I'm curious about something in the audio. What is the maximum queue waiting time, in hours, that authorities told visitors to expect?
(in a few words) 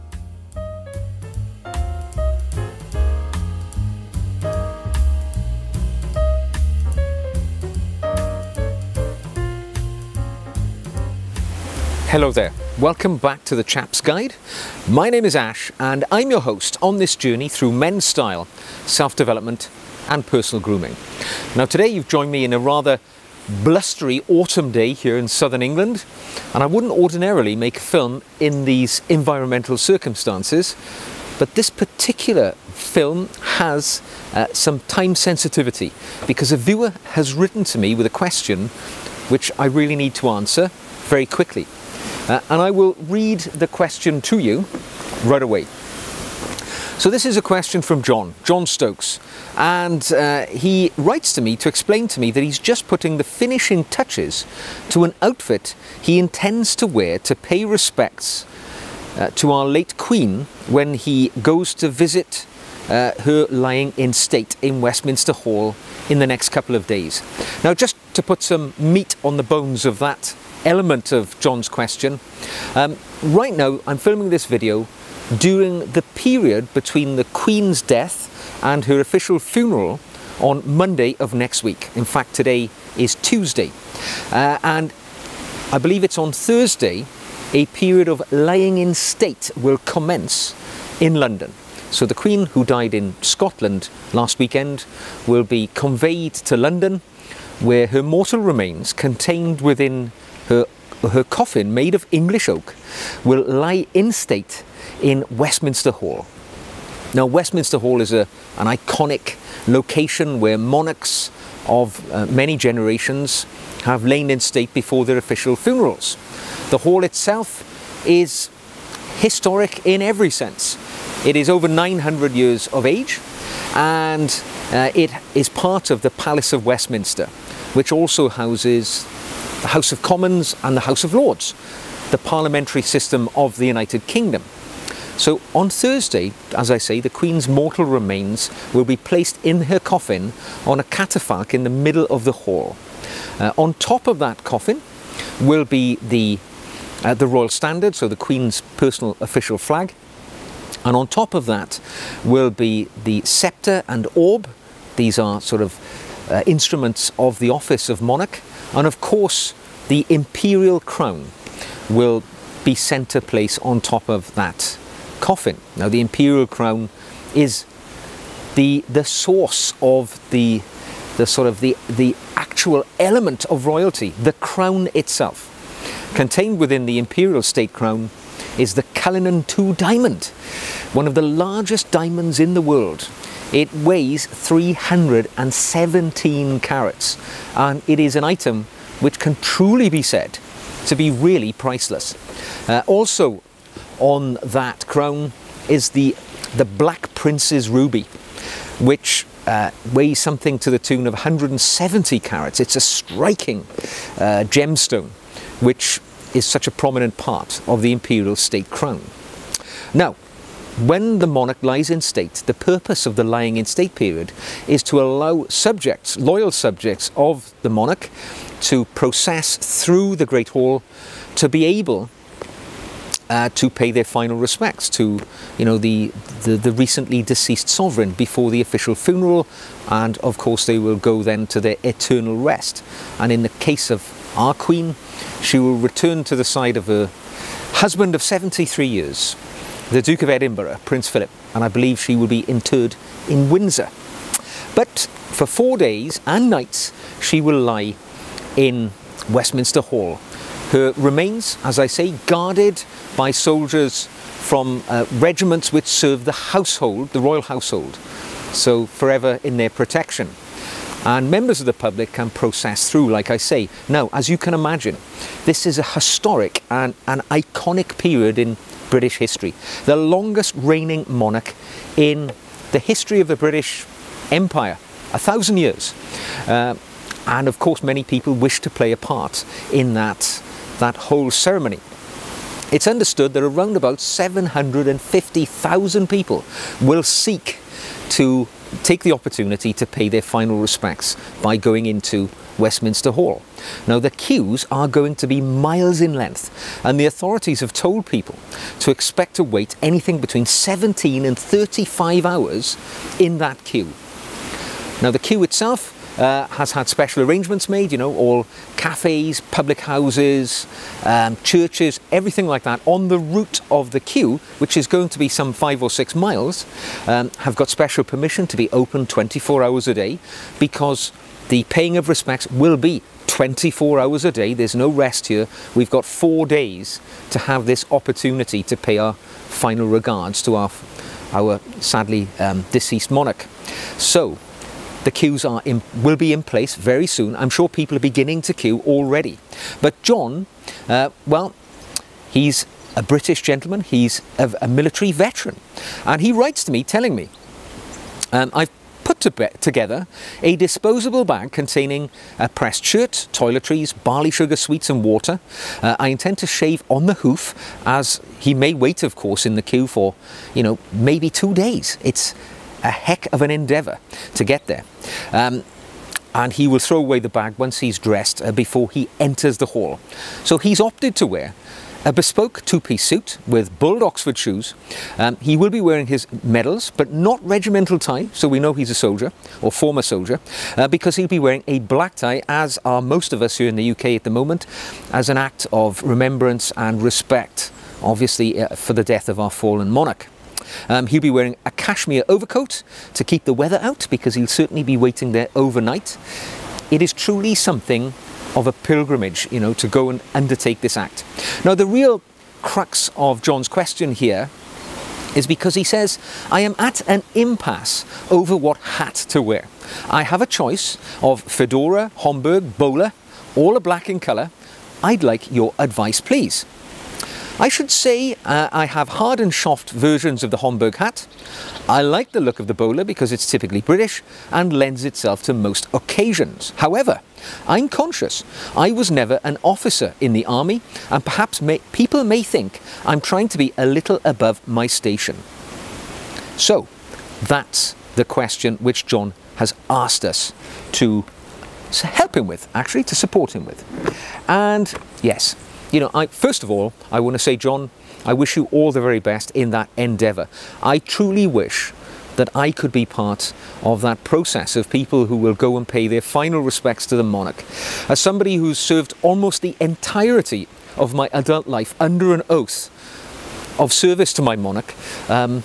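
35 hours.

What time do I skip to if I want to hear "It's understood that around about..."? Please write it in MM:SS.
04:42.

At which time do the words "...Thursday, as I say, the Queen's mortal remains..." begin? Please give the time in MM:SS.
02:15.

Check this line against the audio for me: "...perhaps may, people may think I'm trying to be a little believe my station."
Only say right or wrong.
wrong.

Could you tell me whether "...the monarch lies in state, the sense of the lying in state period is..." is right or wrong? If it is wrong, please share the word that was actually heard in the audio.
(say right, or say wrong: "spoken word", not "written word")
wrong: "purpose", not "sense".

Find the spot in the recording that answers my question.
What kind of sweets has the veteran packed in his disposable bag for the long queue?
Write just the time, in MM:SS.
05:54.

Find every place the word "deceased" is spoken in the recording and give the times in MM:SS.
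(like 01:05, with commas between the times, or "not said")
03:47, 05:32.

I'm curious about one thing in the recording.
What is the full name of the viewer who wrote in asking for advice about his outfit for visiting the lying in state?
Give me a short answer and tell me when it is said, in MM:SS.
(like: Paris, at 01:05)
John Stokes, at 00:48.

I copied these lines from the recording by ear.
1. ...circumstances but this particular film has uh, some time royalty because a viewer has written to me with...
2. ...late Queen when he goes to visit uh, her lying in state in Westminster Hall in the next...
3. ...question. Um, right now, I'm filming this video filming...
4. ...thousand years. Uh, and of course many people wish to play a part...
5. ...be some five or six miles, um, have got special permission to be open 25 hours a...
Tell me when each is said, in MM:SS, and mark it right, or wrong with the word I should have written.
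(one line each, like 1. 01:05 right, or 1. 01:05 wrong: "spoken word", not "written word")
1. 00:29 wrong: "sensitivity", not "royalty"
2. 00:59 right
3. 01:11 wrong: "during", not "filming"
4. 04:35 right
5. 05:15 wrong: "24", not "25".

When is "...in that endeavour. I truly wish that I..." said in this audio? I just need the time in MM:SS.
07:29.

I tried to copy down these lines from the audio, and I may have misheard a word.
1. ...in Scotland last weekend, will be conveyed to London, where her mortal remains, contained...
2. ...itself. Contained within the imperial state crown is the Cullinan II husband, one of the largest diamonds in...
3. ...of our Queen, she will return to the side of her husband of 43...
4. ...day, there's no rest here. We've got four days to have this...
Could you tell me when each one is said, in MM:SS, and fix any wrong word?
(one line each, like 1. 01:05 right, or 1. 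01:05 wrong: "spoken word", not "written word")
1. 01:32 right
2. 02:54 wrong: "diamond", not "husband"
3. 03:53 wrong: "73", not "43"
4. 05:24 right.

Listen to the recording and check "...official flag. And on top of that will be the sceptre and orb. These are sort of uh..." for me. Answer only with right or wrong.
right.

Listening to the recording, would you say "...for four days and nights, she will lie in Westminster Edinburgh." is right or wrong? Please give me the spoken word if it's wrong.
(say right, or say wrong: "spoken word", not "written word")
wrong: "Hall", not "Edinburgh".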